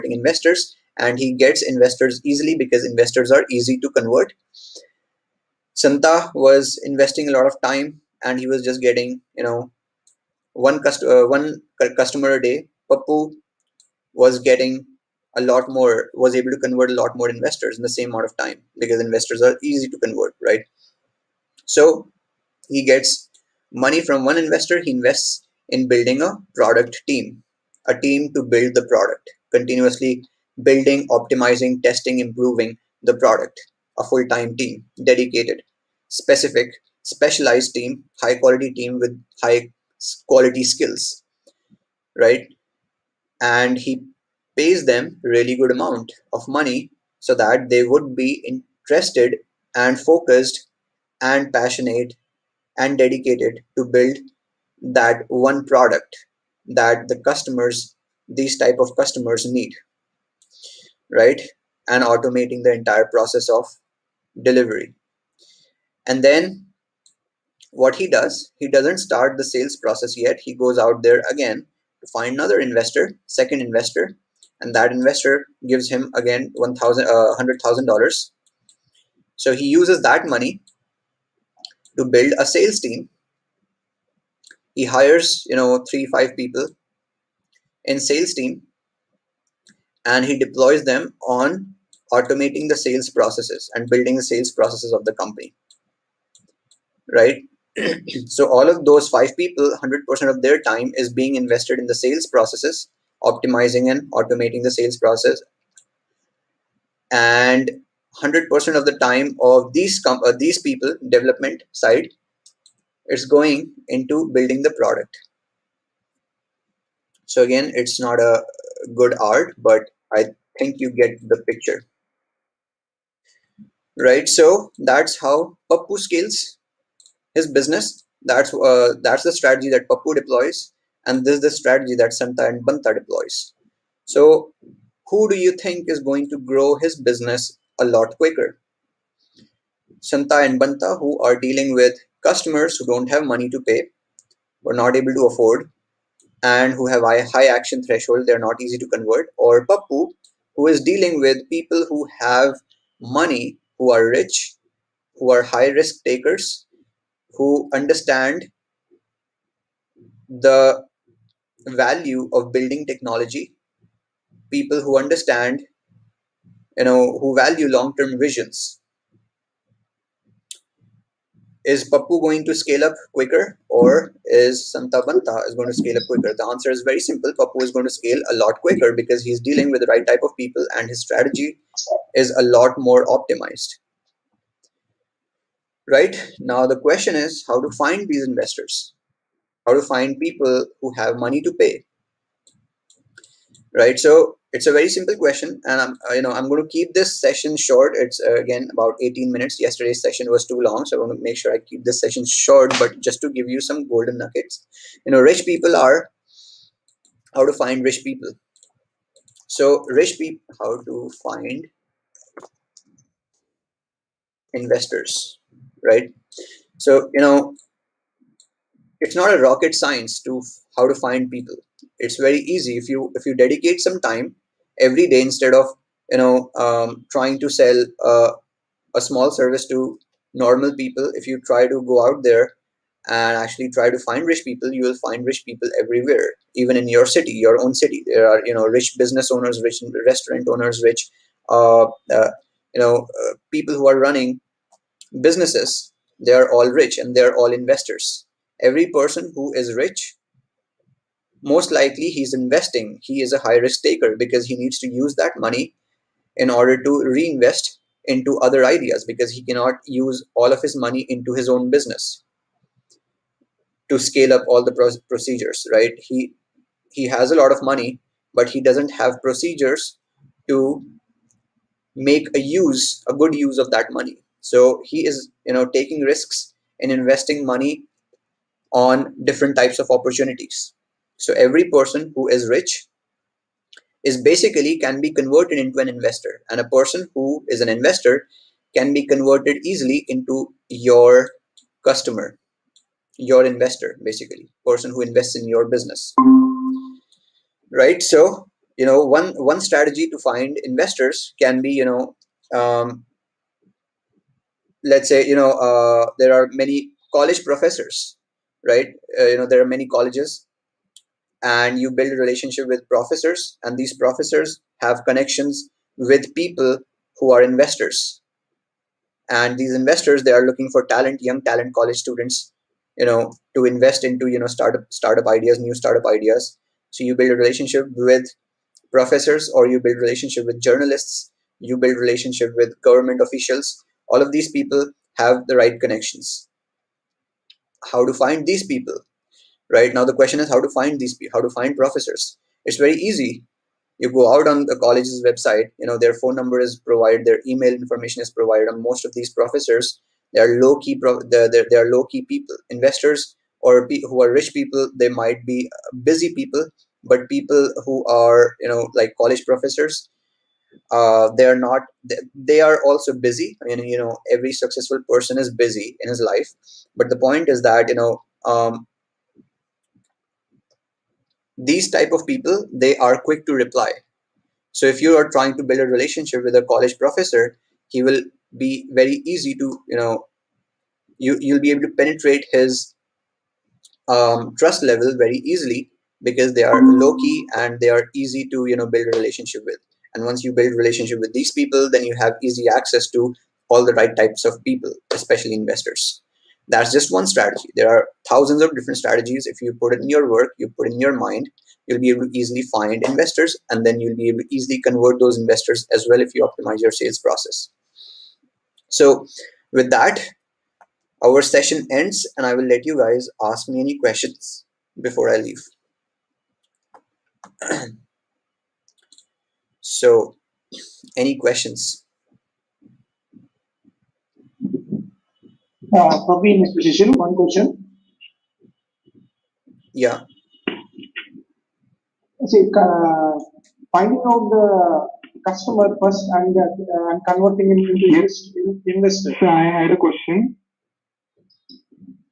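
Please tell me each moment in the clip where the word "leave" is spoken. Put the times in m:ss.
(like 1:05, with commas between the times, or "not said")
6:55.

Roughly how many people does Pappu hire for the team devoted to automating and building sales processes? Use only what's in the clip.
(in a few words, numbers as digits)
3 to 5.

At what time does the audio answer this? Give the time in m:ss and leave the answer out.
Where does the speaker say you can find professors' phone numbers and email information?
5:44.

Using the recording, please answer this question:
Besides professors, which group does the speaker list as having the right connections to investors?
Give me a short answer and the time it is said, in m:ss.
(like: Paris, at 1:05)
Journalists, at 5:30.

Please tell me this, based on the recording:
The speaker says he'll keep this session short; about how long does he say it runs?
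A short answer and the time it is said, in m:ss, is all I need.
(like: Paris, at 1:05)
18 minutes, at 3:19.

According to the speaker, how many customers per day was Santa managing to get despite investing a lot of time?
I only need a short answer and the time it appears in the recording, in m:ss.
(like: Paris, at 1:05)
1, at 0:11.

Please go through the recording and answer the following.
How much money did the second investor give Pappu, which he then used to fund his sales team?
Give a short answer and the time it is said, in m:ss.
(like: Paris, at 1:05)
$100,000, at 1:17.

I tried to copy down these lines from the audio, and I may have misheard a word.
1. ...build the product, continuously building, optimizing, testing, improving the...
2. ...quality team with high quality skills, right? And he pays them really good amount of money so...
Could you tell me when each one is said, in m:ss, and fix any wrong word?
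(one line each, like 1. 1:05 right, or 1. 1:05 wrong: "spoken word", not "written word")
1. 0:28 right
2. 0:38 right.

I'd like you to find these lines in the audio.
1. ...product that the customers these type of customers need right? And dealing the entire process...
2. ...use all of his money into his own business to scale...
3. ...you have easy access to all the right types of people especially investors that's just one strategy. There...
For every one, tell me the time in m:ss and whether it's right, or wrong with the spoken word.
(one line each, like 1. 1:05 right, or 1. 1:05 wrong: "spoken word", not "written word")
1. 0:55 wrong: "automating", not "dealing"
2. 4:19 right
3. 6:32 right.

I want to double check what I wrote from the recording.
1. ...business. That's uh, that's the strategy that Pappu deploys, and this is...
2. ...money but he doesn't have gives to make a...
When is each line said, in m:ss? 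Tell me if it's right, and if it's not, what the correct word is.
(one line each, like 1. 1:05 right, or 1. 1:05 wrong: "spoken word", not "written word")
1. 2:07 right
2. 4:27 wrong: "procedures", not "gives".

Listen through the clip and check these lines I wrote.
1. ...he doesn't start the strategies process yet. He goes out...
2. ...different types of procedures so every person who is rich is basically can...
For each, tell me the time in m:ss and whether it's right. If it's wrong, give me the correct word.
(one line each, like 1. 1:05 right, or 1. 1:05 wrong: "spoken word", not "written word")
1. 1:08 wrong: "sales", not "strategies"
2. 4:39 wrong: "opportunities", not "procedures".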